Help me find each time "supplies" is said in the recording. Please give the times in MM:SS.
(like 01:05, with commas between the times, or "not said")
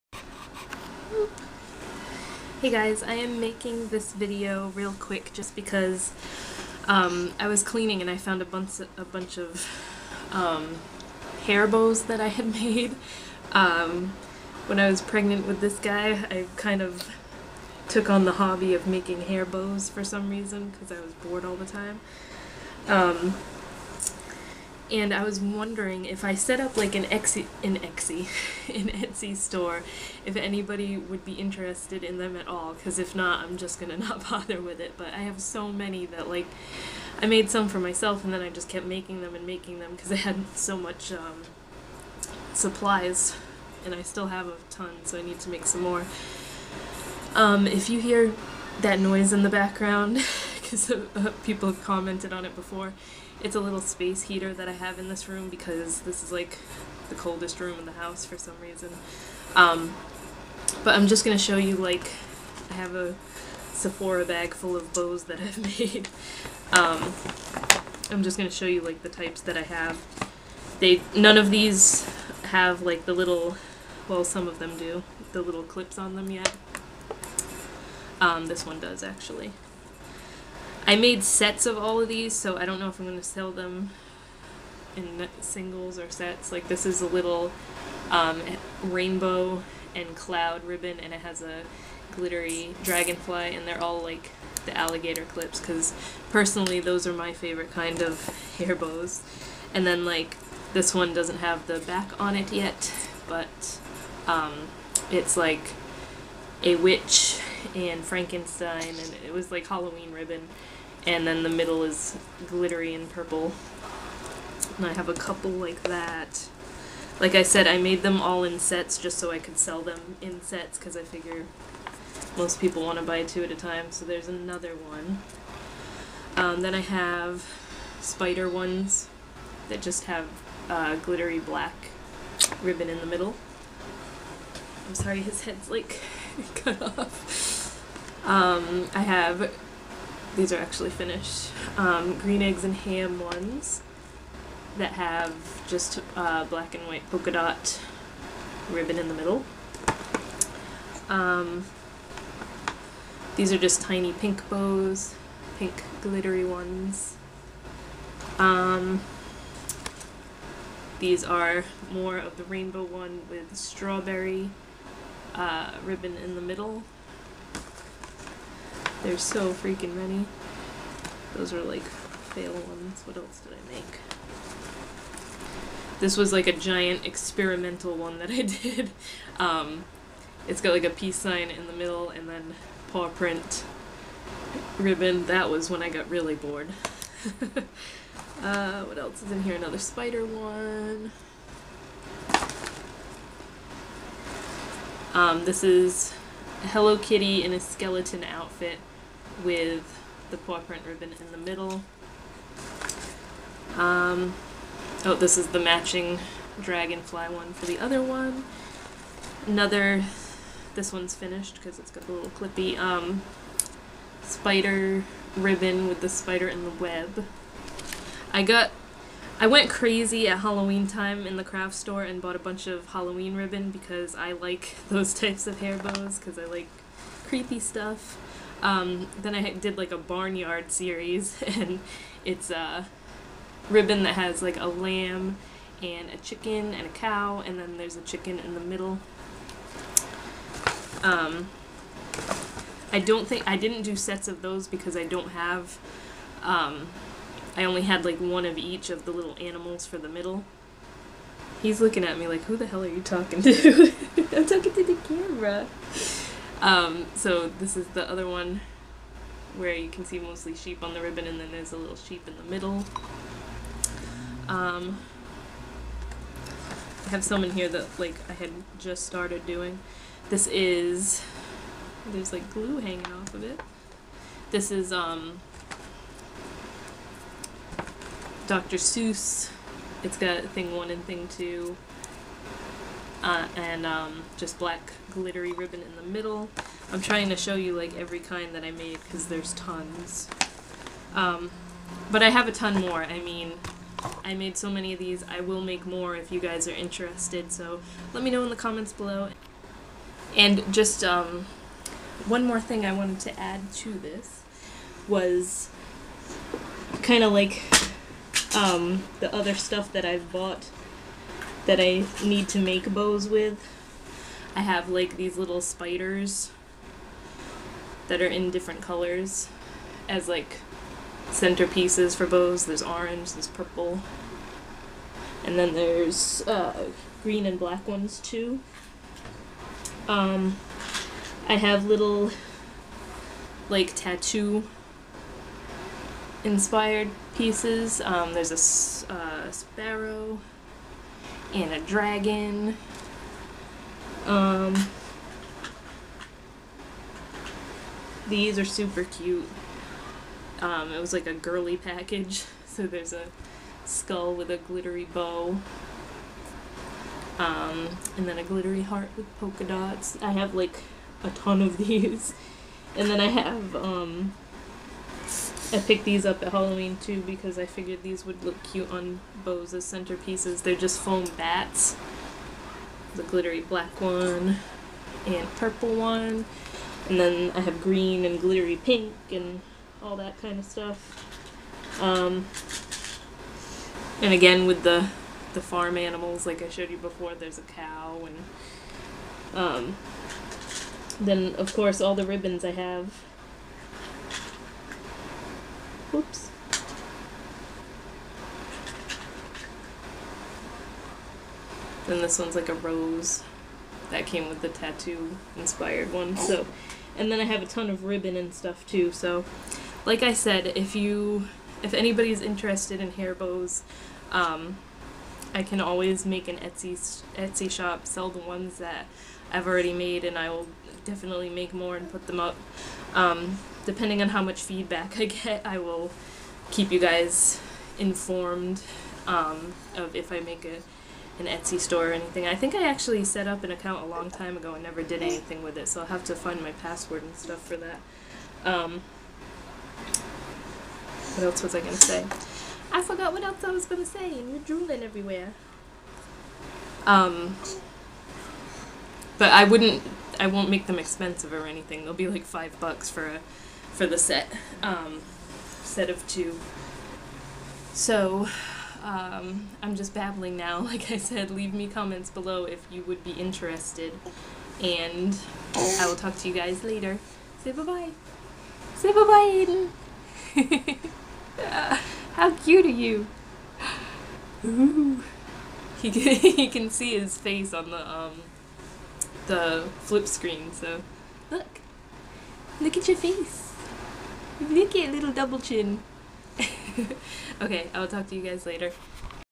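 00:42.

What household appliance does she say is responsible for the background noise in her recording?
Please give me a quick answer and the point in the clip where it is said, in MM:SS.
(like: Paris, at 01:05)
space heater, at 00:53.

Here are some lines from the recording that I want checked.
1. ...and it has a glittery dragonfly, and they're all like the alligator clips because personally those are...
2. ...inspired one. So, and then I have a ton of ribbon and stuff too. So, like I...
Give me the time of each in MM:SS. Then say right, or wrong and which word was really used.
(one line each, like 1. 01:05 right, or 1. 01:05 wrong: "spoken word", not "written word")
1. 01:30 right
2. 06:45 right.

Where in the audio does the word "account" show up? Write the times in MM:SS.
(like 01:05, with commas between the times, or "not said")
07:13.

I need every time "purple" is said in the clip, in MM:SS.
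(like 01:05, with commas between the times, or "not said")
01:53, 05:23, 06:15.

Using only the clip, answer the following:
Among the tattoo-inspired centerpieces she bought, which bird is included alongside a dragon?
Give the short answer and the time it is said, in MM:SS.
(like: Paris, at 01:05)
sparrow, at 05:39.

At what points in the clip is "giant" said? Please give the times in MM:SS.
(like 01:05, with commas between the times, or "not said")
02:56.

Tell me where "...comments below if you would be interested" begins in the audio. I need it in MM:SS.
07:41.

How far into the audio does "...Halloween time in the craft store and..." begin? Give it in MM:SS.
03:40.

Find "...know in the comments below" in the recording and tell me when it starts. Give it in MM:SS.
04:58.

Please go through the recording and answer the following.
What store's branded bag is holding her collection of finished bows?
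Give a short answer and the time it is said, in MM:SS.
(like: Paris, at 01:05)
Sephora, at 01:03.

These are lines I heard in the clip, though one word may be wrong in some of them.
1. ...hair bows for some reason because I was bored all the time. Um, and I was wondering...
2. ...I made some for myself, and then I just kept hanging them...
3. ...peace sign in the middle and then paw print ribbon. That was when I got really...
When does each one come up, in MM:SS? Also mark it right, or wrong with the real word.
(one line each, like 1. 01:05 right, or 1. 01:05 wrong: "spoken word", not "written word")
1. 00:19 right
2. 00:37 wrong: "making", not "hanging"
3. 03:00 right.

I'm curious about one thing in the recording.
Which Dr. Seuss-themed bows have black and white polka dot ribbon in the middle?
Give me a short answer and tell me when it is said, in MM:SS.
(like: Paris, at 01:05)
green eggs and ham, at 02:22.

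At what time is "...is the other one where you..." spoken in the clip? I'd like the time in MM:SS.
04:17.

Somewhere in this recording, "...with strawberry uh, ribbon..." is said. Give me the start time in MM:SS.
02:43.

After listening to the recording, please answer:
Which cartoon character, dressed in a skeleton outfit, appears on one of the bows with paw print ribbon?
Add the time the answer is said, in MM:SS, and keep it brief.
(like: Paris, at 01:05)
Hello Kitty, at 03:16.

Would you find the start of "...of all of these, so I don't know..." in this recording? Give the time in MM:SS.
01:21.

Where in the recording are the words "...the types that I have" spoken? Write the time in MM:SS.
01:09.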